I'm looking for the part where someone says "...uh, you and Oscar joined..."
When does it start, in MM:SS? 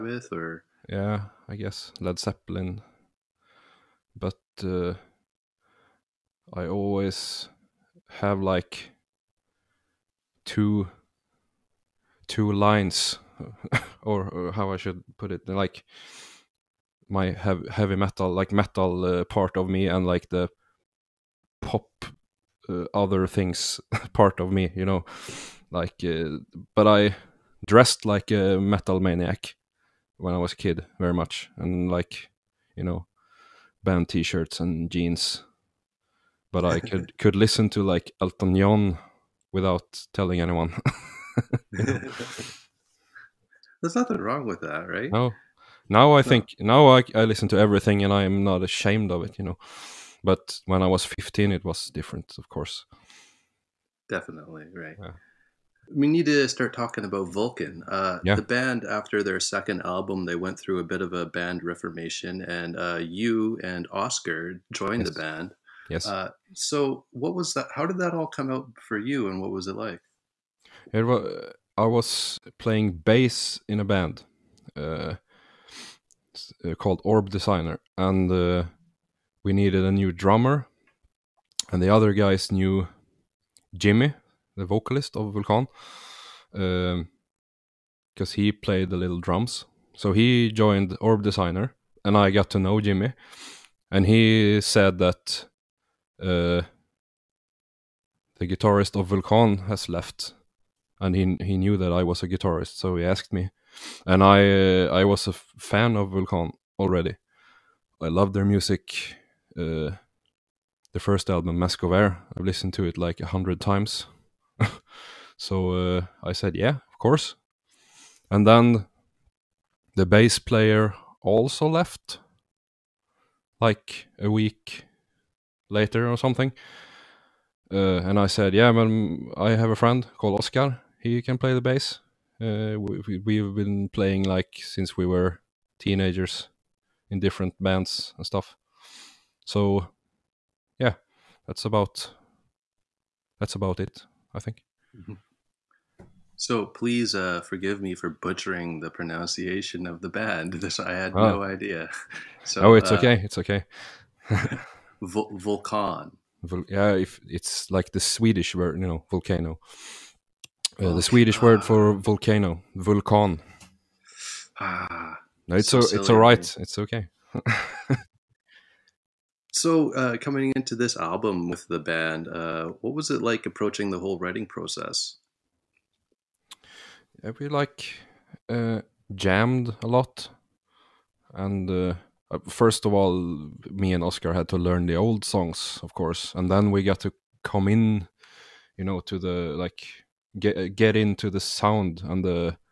01:02.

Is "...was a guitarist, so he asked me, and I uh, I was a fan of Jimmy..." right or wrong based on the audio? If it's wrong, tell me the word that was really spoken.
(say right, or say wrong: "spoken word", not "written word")
wrong: "Vulkan", not "Jimmy".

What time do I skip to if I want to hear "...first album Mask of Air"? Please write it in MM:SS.
01:50.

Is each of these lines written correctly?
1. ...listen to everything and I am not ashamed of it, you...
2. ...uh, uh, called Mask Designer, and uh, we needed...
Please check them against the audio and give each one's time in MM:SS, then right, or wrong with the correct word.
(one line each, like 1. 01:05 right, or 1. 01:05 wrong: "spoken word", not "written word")
1. 00:47 right
2. 01:14 wrong: "Orb", not "Mask".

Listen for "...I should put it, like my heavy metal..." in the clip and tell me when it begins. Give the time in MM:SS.
00:14.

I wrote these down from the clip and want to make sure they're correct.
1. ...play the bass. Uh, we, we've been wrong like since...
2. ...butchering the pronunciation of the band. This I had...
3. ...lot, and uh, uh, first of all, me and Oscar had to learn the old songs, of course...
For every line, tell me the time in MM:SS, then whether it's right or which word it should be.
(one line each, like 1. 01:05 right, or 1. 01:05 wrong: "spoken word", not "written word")
1. 02:11 wrong: "playing", not "wrong"
2. 02:28 right
3. 02:59 right.